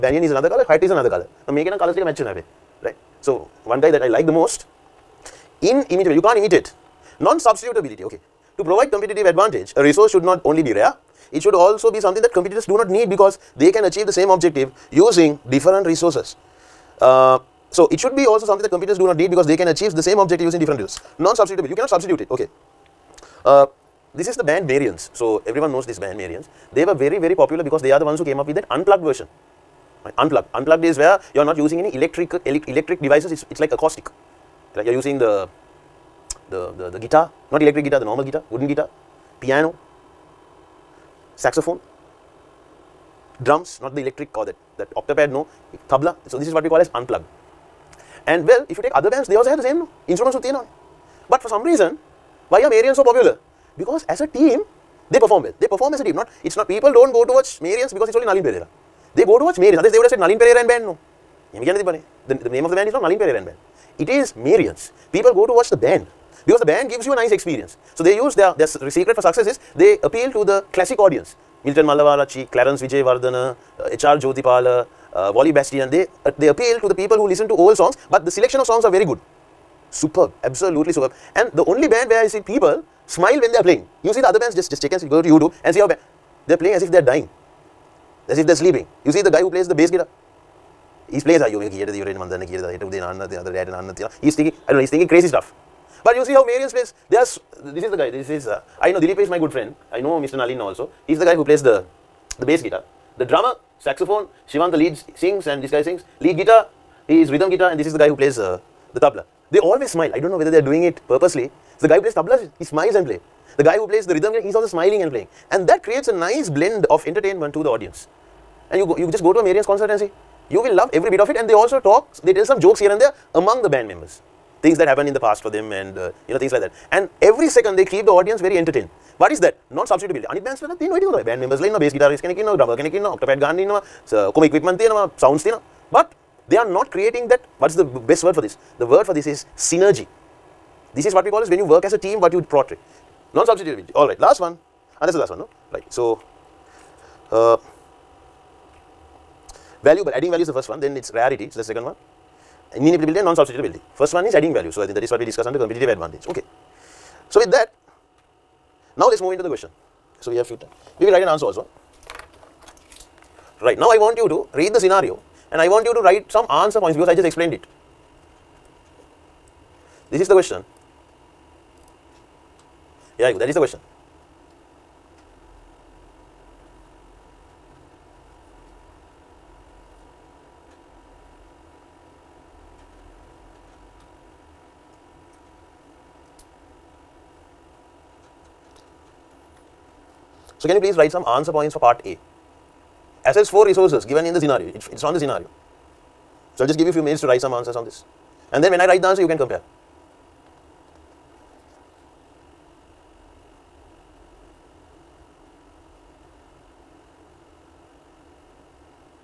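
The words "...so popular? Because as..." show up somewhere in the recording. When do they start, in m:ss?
0:52.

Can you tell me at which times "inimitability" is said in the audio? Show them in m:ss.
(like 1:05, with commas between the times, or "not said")
0:05, 2:32.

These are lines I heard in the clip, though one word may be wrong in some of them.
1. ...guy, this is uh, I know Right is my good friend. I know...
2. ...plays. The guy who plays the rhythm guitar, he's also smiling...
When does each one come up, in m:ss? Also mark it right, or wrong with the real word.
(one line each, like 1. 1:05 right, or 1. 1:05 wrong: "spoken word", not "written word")
1. 1:37 wrong: "Dilip", not "Right"
2. 1:53 right.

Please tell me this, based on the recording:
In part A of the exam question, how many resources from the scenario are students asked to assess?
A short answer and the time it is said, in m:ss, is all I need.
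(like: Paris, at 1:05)
4, at 3:13.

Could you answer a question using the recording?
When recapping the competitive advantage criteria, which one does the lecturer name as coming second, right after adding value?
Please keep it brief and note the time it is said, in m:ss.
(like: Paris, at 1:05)
rarity, at 2:31.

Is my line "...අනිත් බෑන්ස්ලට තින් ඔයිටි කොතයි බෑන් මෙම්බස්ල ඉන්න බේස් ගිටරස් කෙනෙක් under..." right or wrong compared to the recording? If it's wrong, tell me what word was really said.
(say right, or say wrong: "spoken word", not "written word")
wrong: "drummer", not "under".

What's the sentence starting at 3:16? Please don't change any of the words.
So, I'll just give you a few minutes to write some answers on this.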